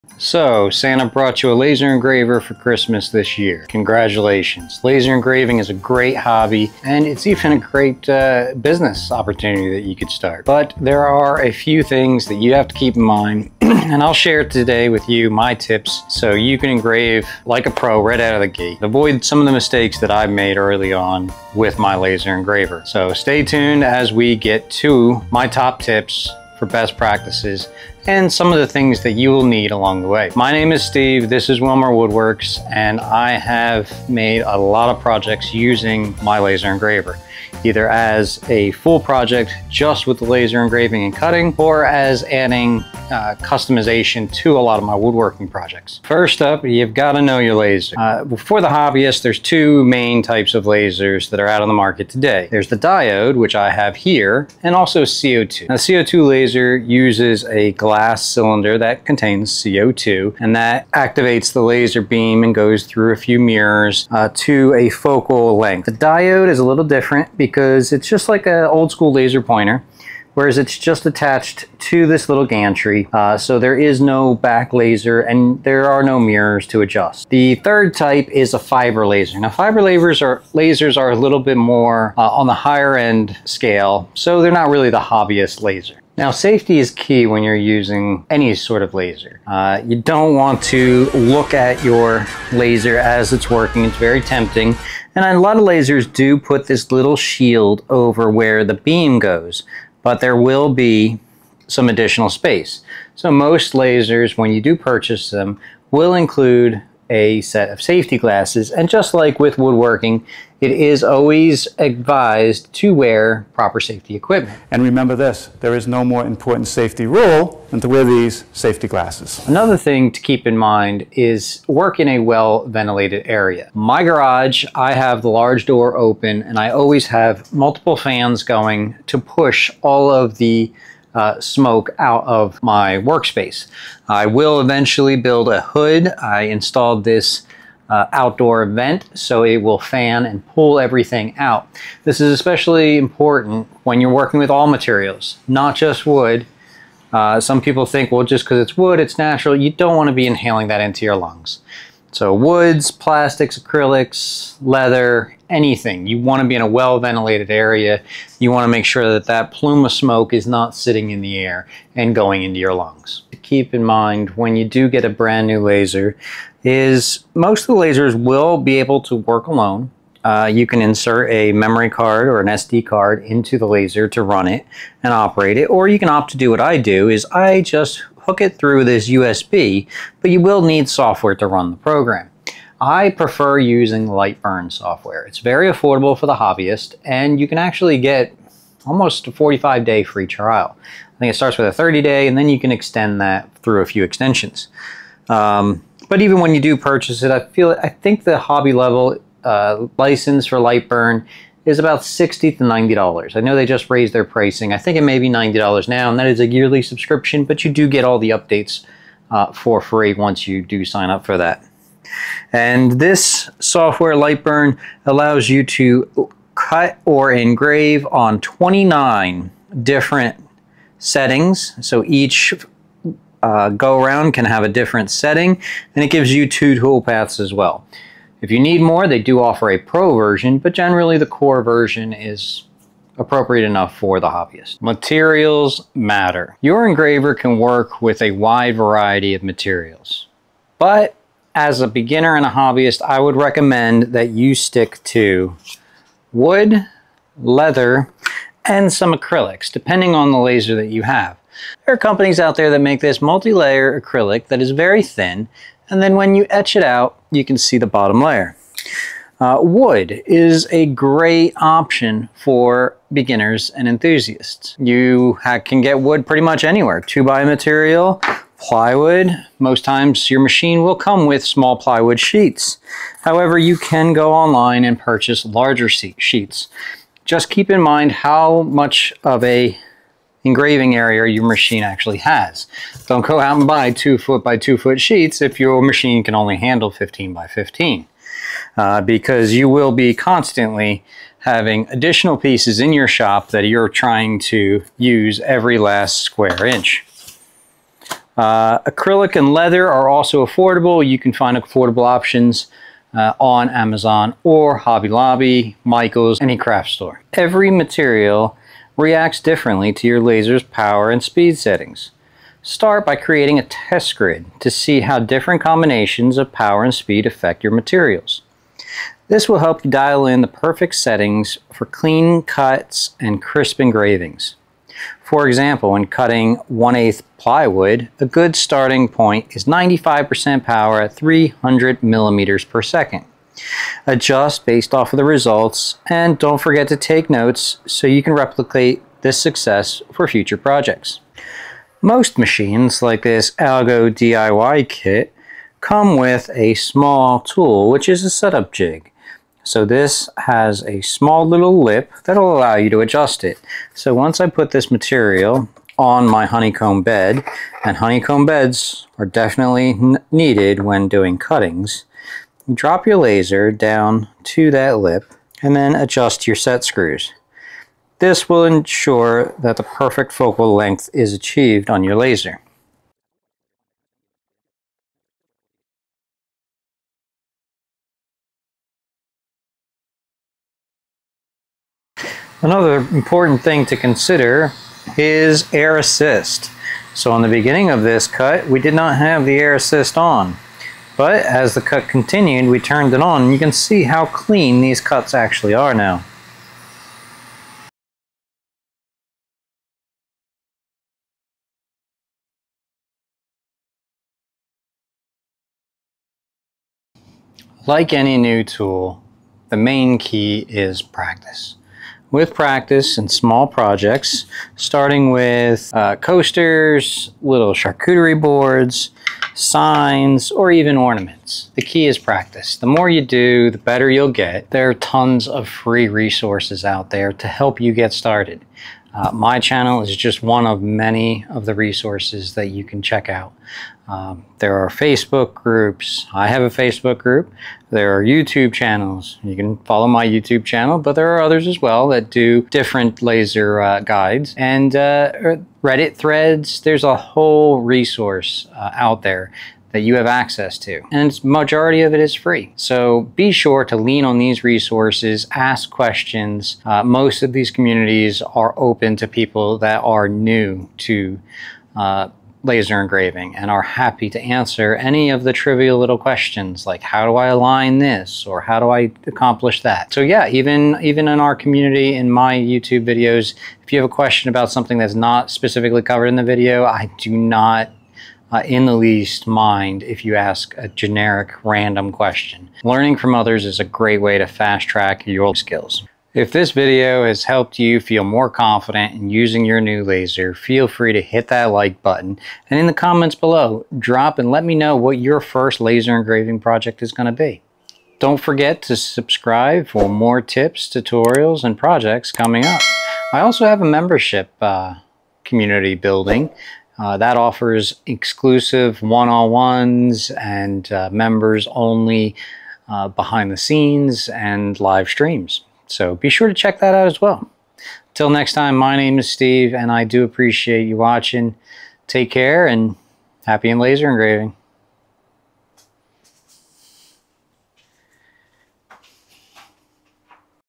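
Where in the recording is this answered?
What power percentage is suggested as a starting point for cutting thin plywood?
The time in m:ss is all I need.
5:29.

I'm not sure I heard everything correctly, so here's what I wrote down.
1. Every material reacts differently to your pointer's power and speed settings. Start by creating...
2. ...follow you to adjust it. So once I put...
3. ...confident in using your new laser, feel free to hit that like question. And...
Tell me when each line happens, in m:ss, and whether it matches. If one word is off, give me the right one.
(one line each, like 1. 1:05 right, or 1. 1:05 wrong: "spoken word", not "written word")
1. 5:07 wrong: "laser", not "pointer"
2. 5:52 wrong: "allow", not "follow"
3. 8:08 wrong: "button", not "question".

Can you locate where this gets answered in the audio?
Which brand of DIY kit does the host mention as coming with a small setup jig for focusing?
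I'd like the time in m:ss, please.
5:43.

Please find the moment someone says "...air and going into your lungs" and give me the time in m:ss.
2:41.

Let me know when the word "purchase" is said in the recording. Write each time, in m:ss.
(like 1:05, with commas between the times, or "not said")
1:44, 3:16, 4:34.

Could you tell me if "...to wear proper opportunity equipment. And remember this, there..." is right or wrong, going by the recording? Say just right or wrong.
wrong.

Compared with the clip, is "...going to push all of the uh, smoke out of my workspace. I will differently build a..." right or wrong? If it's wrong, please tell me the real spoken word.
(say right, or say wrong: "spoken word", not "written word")
wrong: "eventually", not "differently".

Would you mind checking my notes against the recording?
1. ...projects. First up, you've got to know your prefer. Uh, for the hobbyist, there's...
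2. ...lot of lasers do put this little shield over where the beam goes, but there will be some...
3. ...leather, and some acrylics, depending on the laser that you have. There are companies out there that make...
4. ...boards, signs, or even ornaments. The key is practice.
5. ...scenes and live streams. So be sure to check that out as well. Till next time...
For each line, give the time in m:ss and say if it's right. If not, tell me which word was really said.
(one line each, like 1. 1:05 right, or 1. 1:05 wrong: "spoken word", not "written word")
1. 0:45 wrong: "laser", not "prefer"
2. 1:35 right
3. 4:07 right
4. 6:58 right
5. 8:33 right.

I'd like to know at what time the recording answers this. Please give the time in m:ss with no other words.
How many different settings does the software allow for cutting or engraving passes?
3:38.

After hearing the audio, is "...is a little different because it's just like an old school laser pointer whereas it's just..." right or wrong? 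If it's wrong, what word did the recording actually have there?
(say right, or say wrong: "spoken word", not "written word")
right.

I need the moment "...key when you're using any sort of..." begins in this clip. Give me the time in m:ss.
1:26.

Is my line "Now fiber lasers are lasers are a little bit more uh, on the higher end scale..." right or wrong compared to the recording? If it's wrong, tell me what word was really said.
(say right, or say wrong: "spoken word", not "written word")
right.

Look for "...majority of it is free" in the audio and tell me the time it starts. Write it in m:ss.
7:31.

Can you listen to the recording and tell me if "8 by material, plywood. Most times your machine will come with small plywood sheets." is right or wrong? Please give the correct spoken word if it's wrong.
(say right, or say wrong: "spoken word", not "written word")
wrong: "2", not "8".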